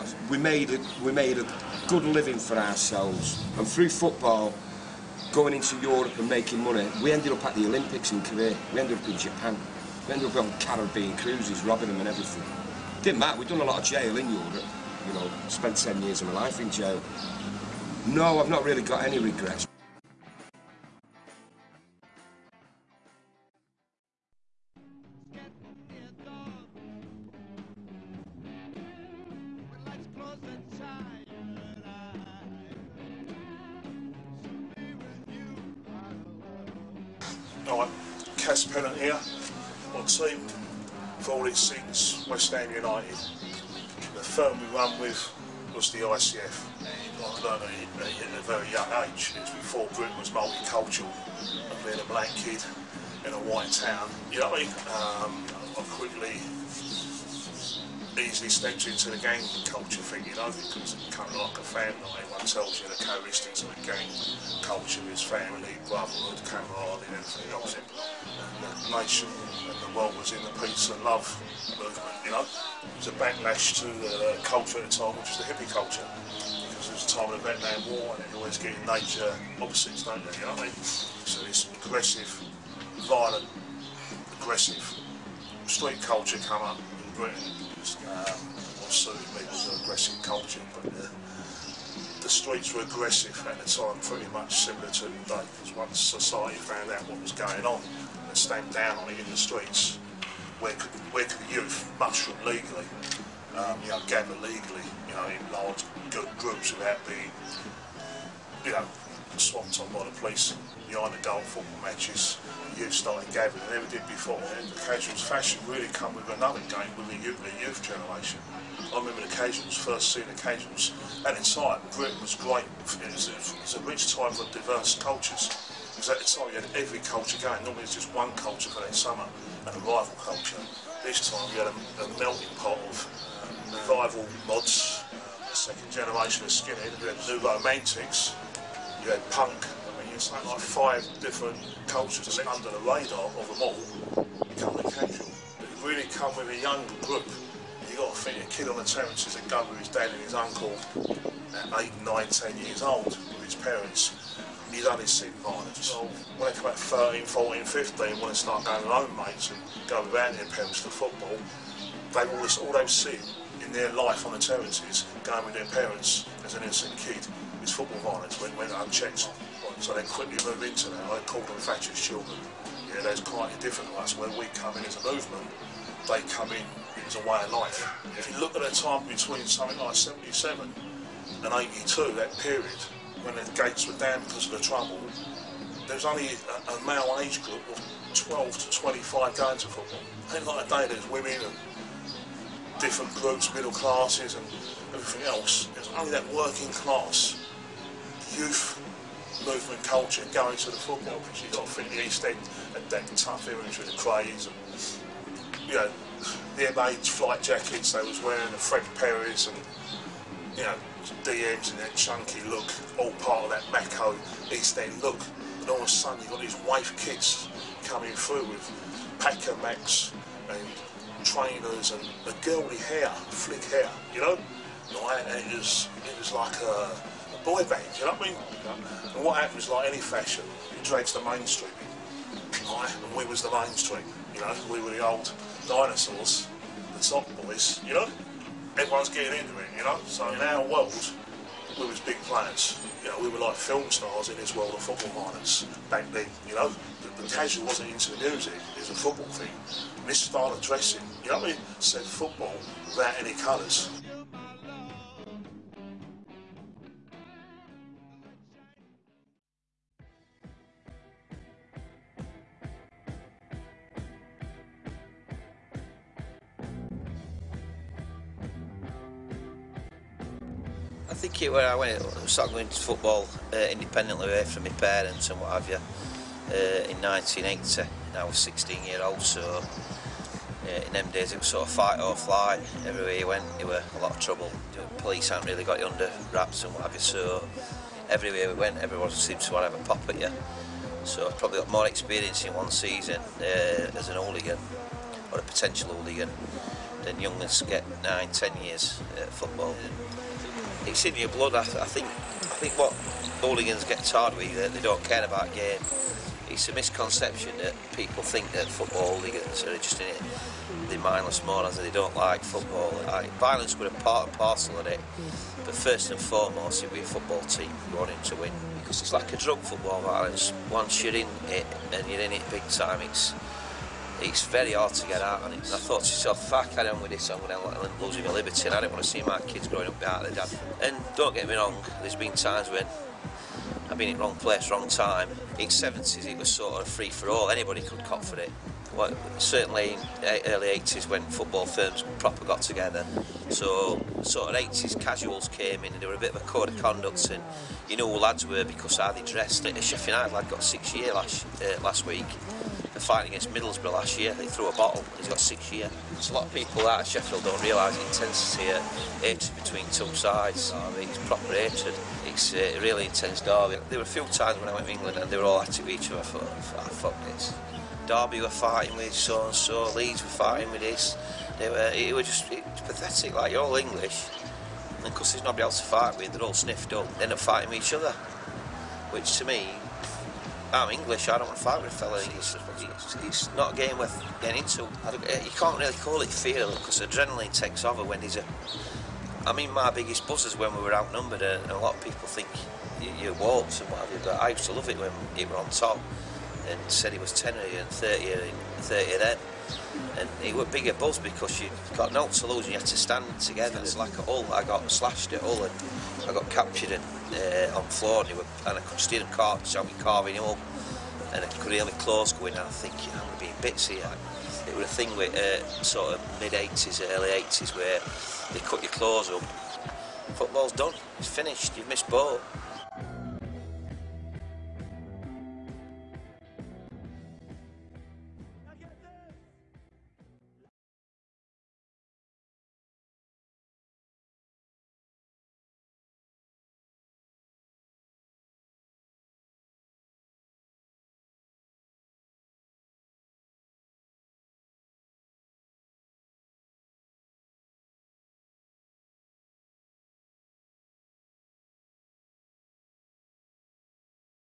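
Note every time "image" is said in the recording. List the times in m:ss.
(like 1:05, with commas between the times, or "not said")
3:23.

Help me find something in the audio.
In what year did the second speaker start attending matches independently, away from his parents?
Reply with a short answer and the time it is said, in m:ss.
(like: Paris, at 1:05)
1980, at 4:36.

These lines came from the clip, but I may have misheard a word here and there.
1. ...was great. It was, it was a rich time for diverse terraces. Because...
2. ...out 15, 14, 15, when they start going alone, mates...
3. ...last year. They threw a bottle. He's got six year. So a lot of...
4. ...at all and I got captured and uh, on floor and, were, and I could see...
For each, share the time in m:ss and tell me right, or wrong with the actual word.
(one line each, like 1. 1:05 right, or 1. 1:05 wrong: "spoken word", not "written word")
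1. 2:02 wrong: "cultures", not "terraces"
2. 2:36 wrong: "13", not "15"
3. 5:53 right
4. 6:45 right.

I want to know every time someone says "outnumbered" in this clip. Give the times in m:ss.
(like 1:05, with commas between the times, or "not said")
6:30.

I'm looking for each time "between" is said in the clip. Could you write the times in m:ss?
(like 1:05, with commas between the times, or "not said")
2:59, 5:59.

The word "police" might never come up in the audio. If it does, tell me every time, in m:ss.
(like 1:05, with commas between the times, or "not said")
1:50, 4:44.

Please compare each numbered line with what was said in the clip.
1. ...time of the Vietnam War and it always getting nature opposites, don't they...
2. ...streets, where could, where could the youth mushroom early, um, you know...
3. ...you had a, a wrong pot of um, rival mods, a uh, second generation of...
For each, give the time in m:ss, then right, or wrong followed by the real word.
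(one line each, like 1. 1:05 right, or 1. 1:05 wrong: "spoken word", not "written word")
1. 1:17 right
2. 1:39 wrong: "legally", not "early"
3. 2:11 wrong: "melting", not "wrong".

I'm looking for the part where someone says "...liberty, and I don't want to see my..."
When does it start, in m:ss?
5:28.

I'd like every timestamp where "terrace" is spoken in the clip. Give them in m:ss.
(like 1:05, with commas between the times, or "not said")
2:28, 2:44.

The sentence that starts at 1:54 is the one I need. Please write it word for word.
The Casuals fashion really come with another game with the youth, the youth generation.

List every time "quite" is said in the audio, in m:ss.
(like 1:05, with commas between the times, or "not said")
2:53.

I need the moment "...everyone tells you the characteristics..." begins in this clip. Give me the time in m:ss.
1:02.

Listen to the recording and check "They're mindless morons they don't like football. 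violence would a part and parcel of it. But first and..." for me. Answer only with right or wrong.
right.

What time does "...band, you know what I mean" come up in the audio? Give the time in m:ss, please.
3:47.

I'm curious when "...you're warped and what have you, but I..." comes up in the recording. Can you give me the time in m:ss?
6:33.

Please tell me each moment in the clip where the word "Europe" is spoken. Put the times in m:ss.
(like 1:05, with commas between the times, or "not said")
0:05, 0:14.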